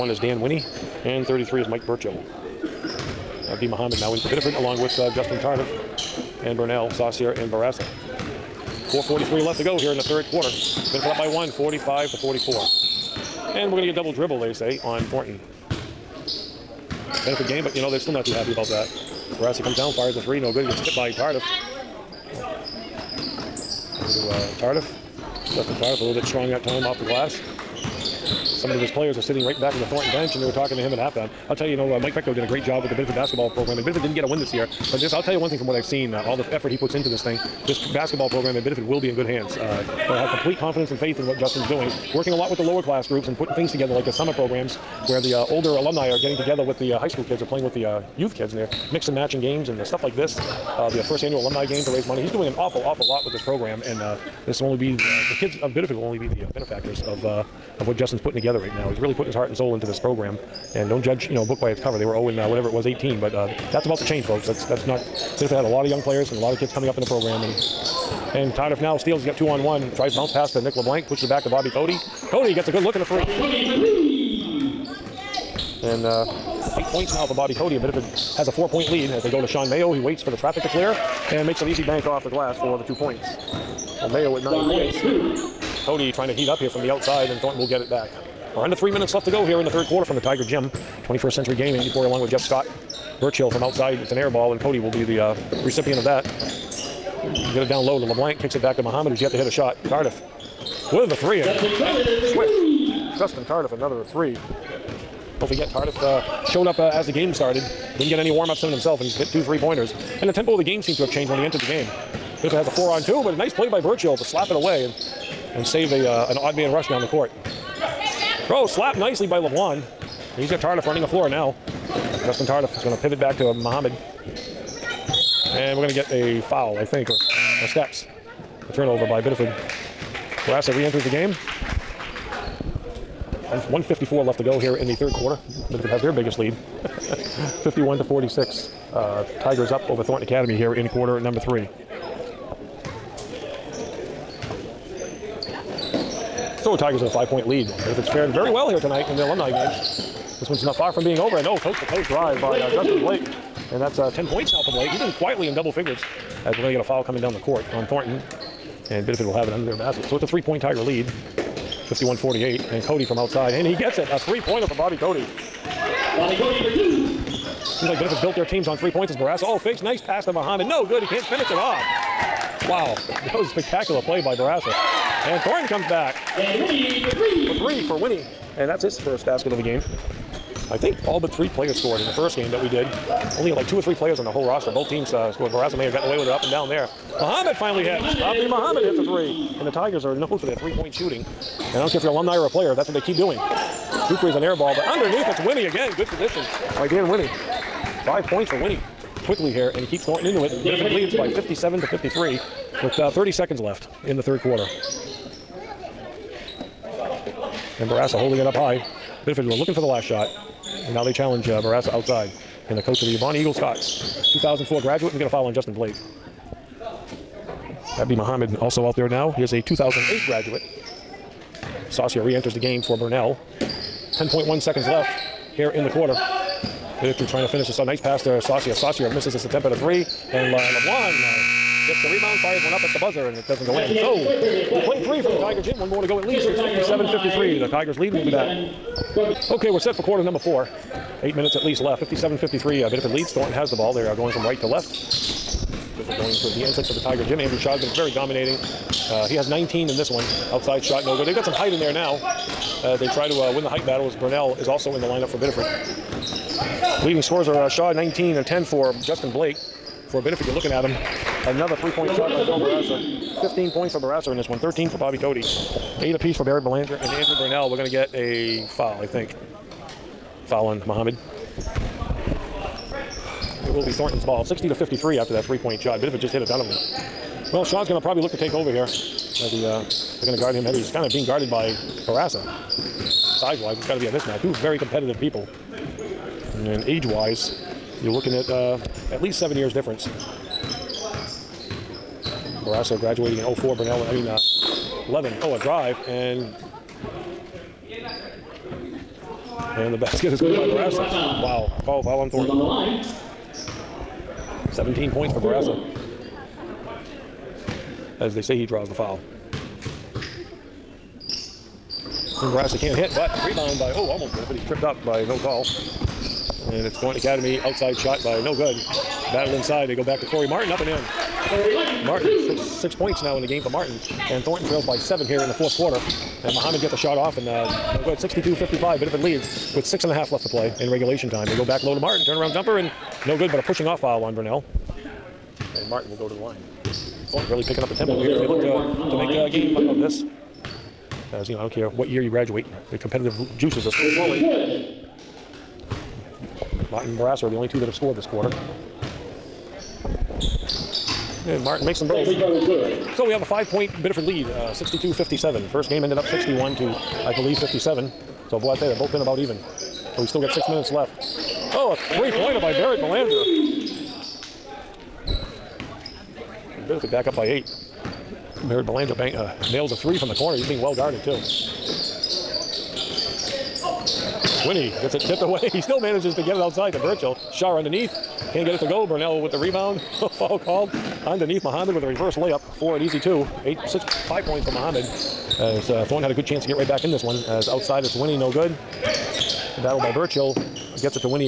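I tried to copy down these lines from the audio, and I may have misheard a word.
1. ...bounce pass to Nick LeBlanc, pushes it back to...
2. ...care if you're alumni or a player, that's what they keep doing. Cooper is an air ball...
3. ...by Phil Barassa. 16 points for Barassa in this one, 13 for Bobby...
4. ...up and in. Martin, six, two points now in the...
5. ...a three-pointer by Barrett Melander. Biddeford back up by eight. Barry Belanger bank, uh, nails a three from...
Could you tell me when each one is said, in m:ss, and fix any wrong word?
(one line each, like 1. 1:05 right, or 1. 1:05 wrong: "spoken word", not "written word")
1. 1:10 right
2. 3:11 right
3. 4:22 wrong: "15", not "16"
4. 5:20 wrong: "six", not "two"
5. 6:01 right.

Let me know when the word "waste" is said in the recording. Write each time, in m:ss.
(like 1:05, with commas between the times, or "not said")
not said.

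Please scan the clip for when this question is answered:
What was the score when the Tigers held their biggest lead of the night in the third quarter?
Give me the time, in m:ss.
2:17.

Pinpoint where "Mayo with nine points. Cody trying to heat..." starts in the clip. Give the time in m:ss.
1:24.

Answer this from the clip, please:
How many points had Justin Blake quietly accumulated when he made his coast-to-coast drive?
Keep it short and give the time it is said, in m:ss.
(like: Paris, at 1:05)
10, at 2:34.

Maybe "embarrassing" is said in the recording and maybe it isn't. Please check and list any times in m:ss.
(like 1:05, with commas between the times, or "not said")
not said.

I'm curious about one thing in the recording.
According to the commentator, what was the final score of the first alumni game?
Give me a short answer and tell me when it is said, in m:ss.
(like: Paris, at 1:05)
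61 to 57, at 5:56.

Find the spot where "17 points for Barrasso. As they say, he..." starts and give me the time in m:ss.
5:04.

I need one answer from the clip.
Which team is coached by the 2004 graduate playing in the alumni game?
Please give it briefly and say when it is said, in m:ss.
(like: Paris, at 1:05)
Bonnie Eagle Scots, at 3:33.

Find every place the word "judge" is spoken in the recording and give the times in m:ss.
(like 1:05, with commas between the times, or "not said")
1:01.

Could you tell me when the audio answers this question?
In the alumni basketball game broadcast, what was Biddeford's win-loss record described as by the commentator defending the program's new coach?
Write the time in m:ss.
1:02.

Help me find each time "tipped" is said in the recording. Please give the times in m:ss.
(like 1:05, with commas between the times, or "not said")
0:20, 6:15.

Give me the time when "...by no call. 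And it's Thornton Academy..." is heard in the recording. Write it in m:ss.
5:15.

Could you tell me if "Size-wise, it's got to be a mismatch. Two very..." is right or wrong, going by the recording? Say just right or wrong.
right.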